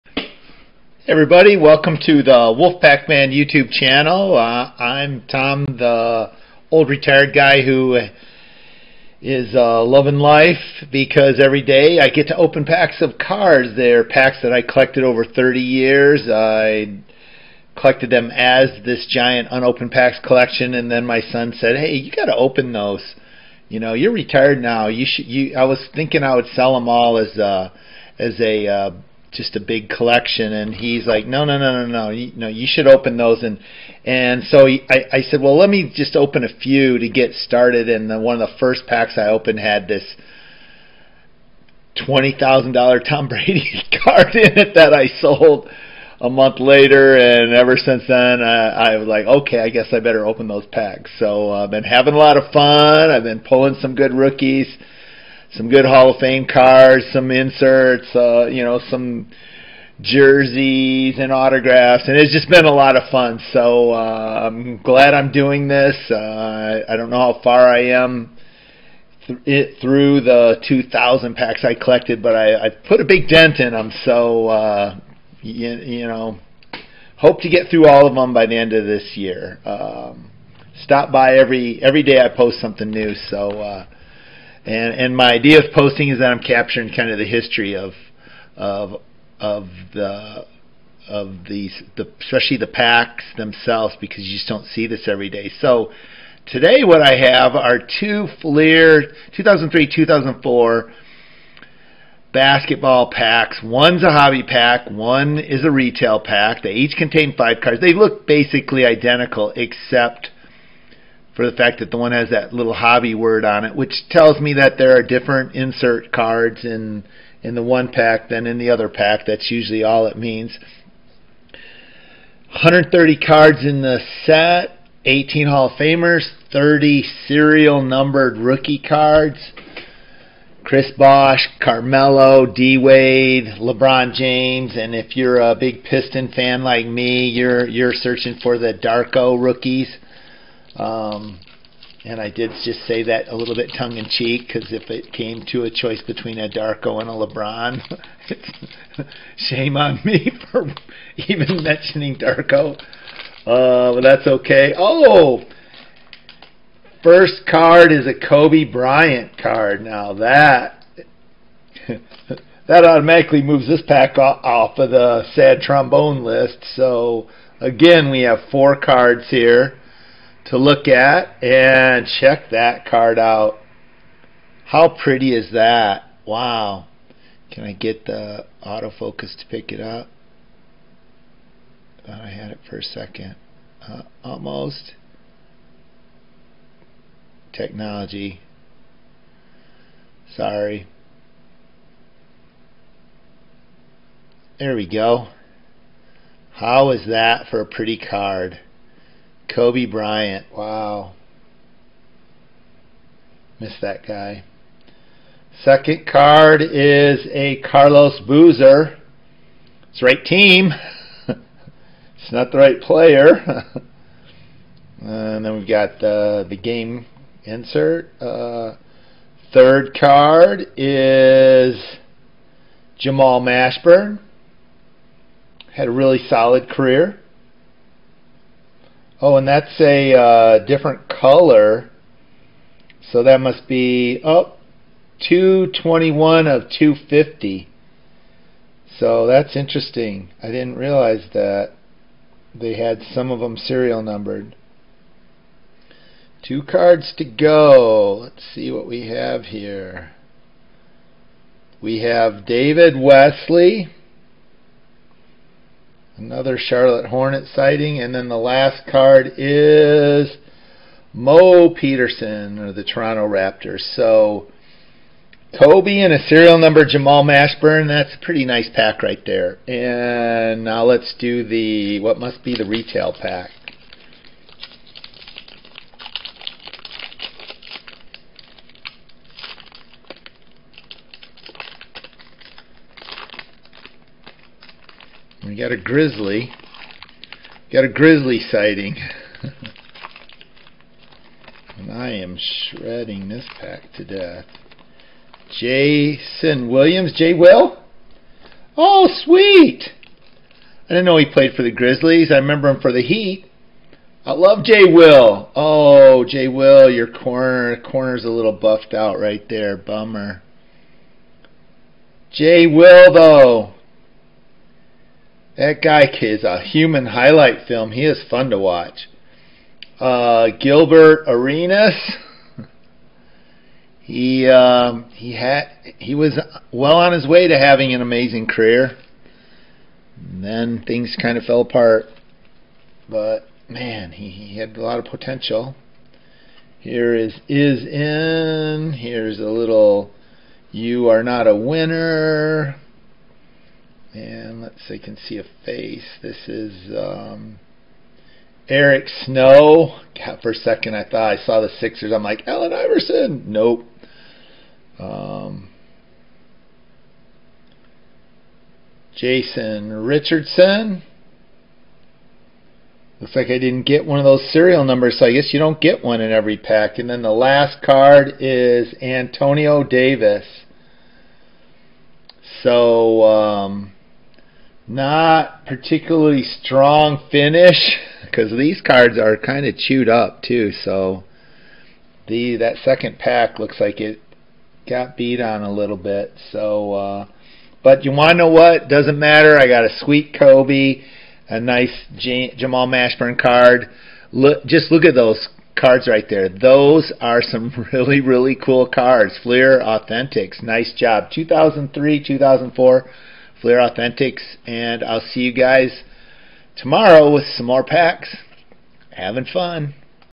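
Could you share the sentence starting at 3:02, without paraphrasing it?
Thought I had it for a second.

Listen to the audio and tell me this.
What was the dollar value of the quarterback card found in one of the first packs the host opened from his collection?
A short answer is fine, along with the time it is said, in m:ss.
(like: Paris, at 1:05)
$20,000, at 0:42.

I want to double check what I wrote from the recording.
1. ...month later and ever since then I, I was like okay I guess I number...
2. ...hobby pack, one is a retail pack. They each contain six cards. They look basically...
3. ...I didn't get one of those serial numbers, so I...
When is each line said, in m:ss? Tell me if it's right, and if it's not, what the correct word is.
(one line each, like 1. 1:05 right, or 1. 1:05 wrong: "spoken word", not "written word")
1. 0:46 wrong: "better", not "number"
2. 1:44 wrong: "five", not "six"
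3. 6:03 right.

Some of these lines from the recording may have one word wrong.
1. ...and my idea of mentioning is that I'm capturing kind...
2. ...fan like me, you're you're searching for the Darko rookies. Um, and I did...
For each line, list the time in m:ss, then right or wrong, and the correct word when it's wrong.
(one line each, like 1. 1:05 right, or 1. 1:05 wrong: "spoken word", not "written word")
1. 1:24 wrong: "posting", not "mentioning"
2. 2:16 right.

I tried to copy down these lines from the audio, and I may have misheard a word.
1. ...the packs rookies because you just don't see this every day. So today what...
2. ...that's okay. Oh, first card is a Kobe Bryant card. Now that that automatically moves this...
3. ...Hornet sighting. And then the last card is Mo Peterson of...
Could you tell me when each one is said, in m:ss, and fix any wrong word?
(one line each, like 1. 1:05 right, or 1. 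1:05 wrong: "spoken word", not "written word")
1. 1:32 wrong: "themselves", not "rookies"
2. 2:34 right
3. 4:17 right.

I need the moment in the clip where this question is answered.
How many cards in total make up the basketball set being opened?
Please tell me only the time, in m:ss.
2:02.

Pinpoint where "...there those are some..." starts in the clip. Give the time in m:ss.
6:36.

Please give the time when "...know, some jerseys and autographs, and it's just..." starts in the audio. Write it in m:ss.
0:58.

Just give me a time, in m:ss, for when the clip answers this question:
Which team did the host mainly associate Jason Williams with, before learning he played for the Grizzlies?
5:03.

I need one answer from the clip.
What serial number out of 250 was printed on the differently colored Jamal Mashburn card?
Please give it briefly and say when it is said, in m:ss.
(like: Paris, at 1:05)
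221, at 3:55.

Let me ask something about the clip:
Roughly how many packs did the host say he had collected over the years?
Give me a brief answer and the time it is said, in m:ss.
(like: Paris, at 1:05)
2,000, at 1:10.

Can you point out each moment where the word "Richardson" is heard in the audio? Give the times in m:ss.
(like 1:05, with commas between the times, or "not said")
6:00.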